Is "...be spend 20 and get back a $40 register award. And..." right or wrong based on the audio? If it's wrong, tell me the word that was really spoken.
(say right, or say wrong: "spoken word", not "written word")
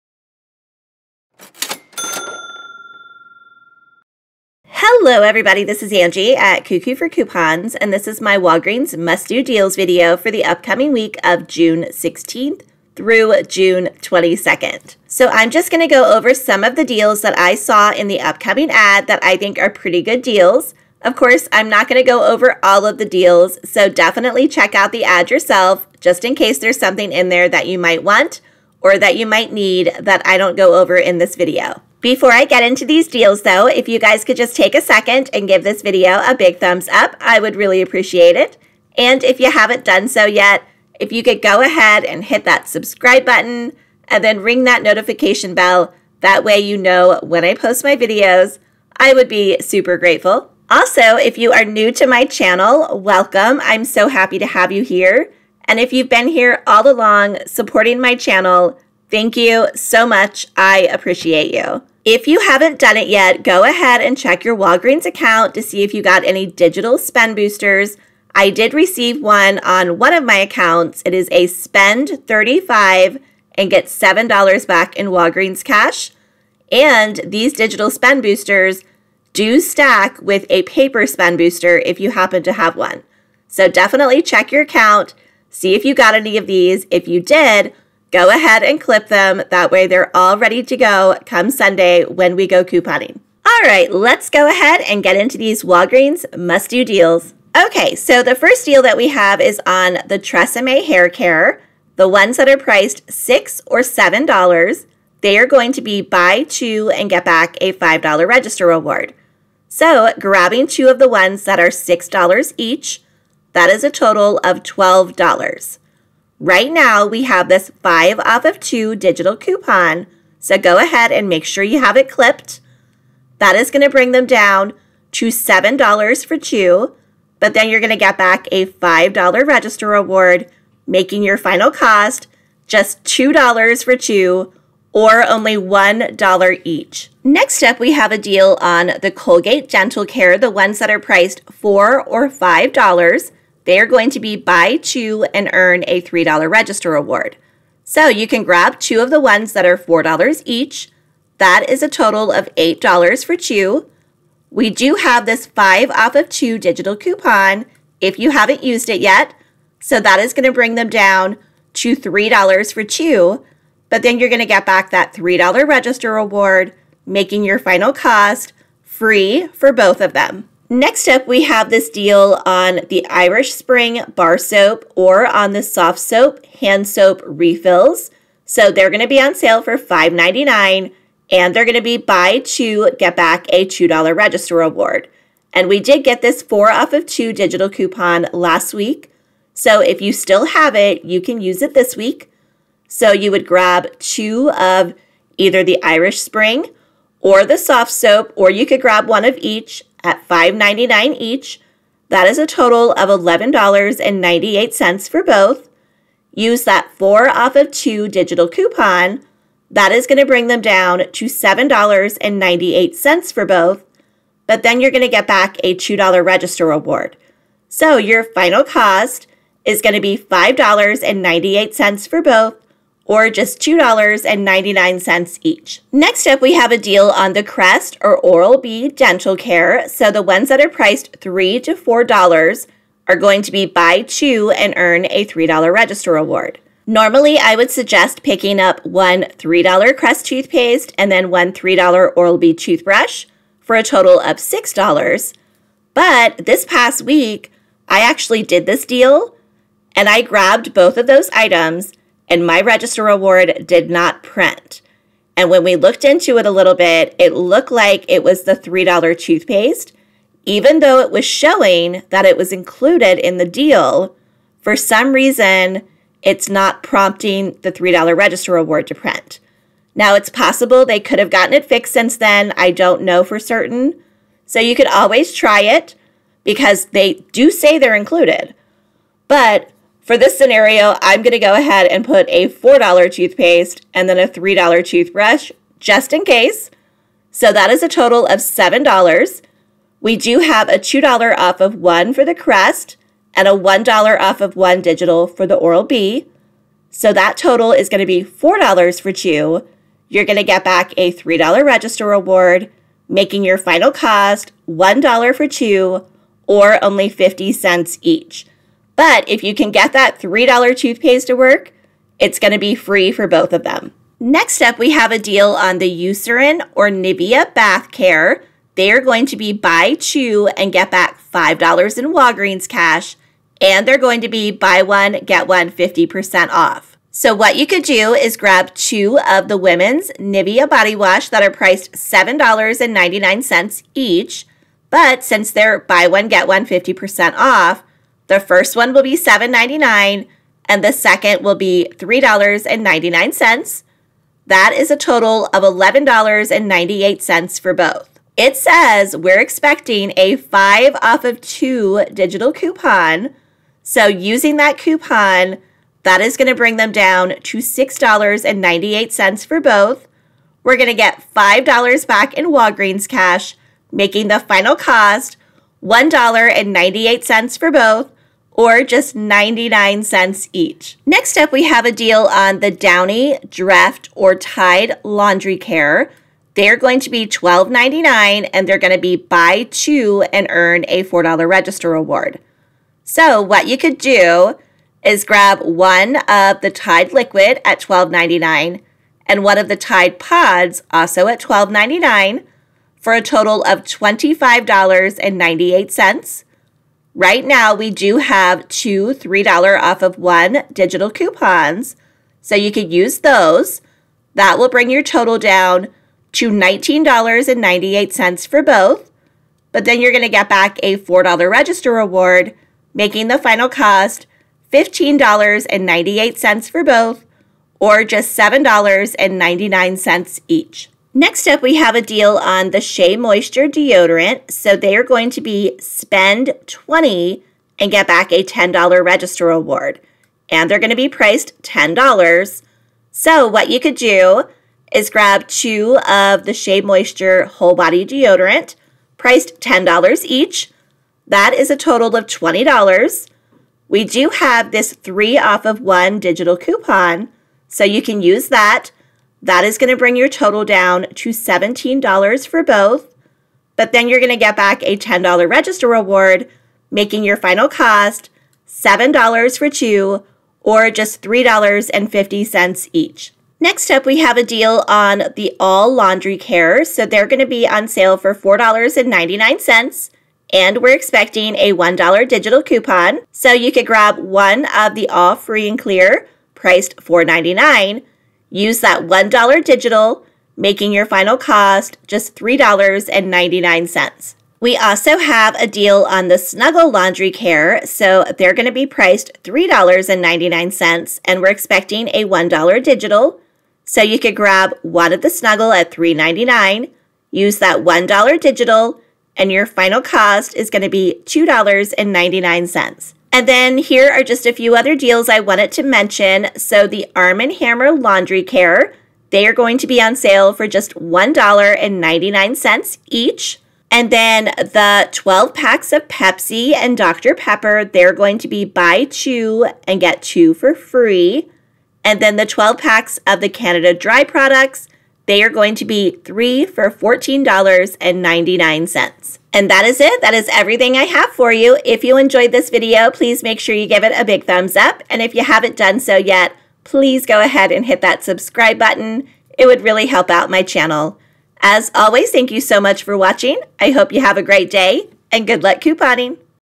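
wrong: "10", not "40".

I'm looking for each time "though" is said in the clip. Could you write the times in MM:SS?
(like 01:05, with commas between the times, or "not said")
00:33, 04:20.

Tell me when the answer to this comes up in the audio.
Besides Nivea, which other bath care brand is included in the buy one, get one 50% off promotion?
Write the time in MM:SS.
05:15.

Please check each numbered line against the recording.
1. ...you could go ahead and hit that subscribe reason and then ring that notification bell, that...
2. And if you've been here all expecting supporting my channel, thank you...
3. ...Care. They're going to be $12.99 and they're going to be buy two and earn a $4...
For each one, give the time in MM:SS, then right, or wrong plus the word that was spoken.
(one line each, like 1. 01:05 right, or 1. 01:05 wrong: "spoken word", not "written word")
1. 00:41 wrong: "button", not "reason"
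2. 00:55 wrong: "along", not "expecting"
3. 06:15 right.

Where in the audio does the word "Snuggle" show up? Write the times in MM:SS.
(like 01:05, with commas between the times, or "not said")
08:06, 08:15.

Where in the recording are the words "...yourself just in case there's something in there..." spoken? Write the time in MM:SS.
00:25.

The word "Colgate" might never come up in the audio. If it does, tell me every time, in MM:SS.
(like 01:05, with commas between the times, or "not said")
02:19.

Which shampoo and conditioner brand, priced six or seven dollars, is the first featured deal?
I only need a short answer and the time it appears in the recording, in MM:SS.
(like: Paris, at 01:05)
Tresemme, at 01:40.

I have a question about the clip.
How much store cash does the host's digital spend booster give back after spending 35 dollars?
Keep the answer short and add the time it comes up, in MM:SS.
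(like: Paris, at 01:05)
$7, at 01:13.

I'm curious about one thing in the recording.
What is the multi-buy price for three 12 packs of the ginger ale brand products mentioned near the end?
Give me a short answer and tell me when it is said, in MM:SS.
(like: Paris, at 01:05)
$14.99, at 08:46.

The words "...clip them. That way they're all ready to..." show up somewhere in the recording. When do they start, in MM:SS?
01:28.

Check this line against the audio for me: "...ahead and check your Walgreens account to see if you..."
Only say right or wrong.
right.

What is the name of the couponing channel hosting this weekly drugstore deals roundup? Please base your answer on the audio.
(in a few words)
Coo Coo for Coupons.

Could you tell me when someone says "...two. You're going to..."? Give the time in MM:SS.
04:59.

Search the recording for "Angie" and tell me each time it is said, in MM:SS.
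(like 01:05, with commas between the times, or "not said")
00:05.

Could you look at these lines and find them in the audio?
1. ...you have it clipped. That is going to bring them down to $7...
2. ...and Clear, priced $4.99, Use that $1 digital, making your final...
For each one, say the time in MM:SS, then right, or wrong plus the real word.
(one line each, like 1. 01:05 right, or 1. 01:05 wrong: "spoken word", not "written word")
1. 02:01 right
2. 07:55 right.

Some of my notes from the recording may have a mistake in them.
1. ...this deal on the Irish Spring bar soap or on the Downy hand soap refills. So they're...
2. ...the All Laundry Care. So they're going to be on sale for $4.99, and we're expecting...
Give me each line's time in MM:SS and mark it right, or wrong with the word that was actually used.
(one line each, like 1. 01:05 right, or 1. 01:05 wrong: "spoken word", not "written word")
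1. 02:51 wrong: "Softsoap", not "Downy"
2. 07:45 right.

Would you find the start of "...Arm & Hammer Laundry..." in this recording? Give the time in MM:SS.
08:27.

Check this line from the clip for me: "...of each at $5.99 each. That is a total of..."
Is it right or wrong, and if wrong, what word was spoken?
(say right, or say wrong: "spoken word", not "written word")
right.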